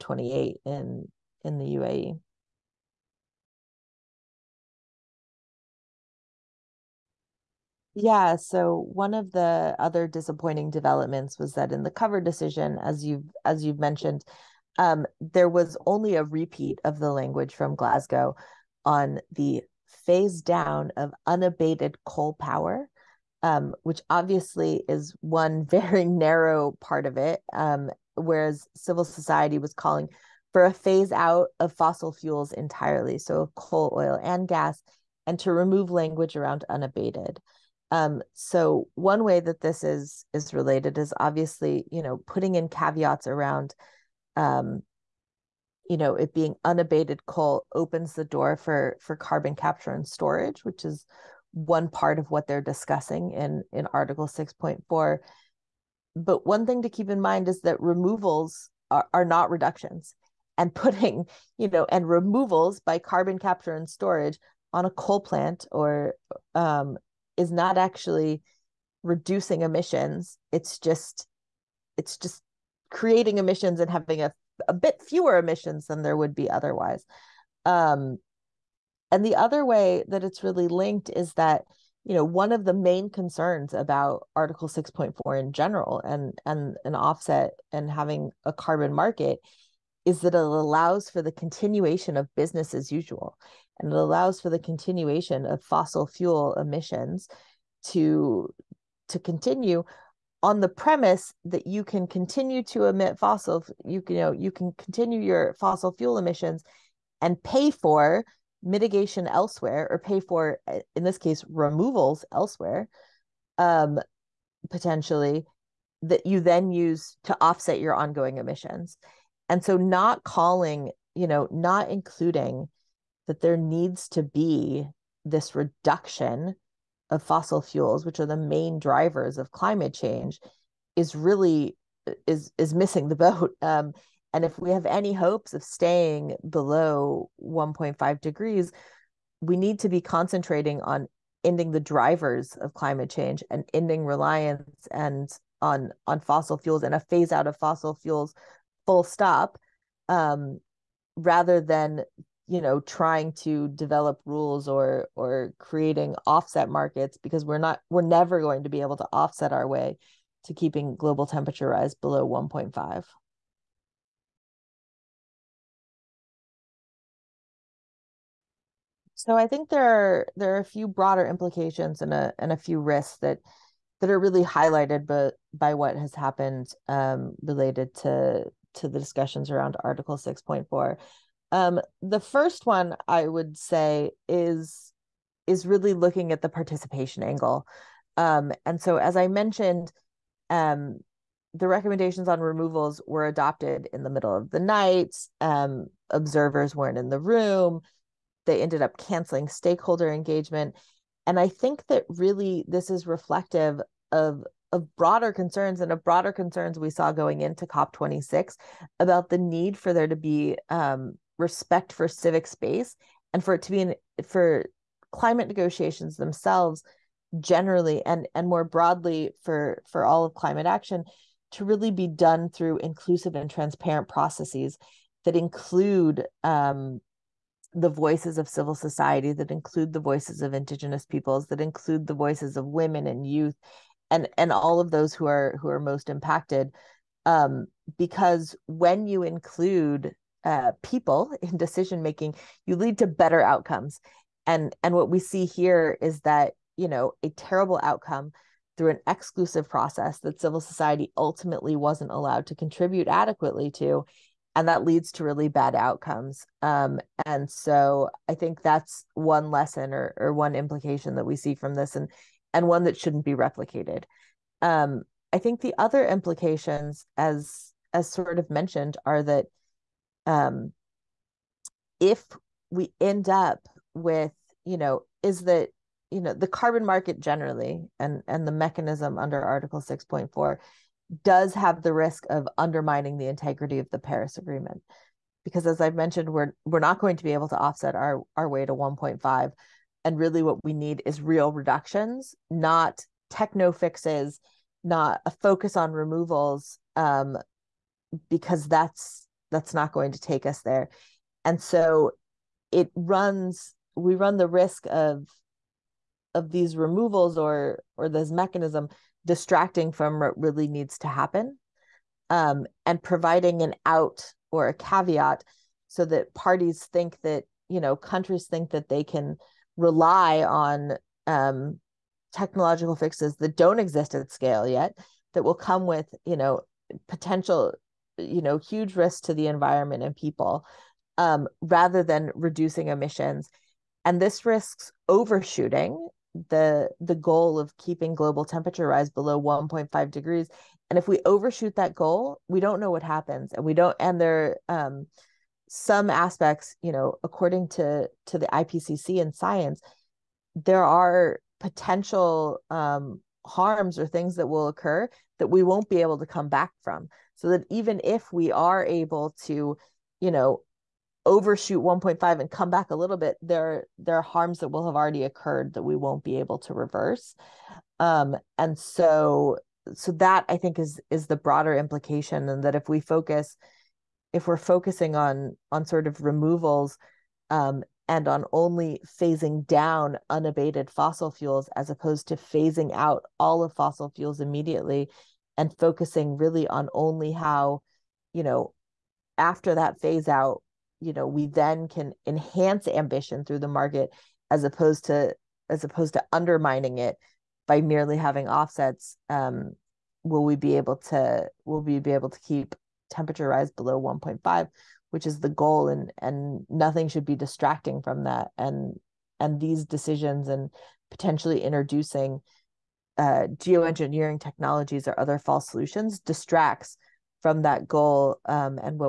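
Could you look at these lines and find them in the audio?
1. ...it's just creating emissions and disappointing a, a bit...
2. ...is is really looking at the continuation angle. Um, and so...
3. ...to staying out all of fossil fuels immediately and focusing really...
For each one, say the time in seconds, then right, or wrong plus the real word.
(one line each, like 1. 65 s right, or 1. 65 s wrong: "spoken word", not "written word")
1. 71 s wrong: "having", not "disappointing"
2. 184 s wrong: "participation", not "continuation"
3. 382 s wrong: "phasing", not "staying".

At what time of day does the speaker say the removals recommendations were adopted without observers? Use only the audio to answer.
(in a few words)
middle of the night.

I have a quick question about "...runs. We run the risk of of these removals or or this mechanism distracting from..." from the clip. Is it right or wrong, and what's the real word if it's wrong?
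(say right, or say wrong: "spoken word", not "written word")
right.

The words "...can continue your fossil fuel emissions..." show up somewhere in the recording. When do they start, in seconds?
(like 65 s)
104 s.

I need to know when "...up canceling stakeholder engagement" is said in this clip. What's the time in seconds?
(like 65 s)
198 s.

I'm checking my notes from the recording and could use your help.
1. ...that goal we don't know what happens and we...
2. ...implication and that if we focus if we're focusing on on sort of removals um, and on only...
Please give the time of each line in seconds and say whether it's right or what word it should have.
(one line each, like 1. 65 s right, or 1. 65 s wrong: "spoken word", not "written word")
1. 341 s right
2. 371 s right.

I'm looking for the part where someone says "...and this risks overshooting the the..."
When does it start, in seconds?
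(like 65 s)
334 s.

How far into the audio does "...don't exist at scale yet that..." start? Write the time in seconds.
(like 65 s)
323 s.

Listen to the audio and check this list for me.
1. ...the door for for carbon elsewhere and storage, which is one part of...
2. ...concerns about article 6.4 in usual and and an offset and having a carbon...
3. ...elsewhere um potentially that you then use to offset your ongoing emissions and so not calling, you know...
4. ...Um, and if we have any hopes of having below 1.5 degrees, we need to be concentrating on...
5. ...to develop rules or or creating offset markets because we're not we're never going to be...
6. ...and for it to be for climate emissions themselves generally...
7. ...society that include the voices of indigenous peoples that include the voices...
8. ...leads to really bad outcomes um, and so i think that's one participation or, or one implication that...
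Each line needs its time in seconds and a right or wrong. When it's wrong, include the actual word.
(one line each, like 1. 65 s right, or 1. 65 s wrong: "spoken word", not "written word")
1. 48 s wrong: "capture", not "elsewhere"
2. 83 s wrong: "general", not "usual"
3. 112 s right
4. 133 s wrong: "staying", not "having"
5. 153 s right
6. 213 s wrong: "negotiations", not "emissions"
7. 228 s right
8. 254 s wrong: "lesson", not "participation".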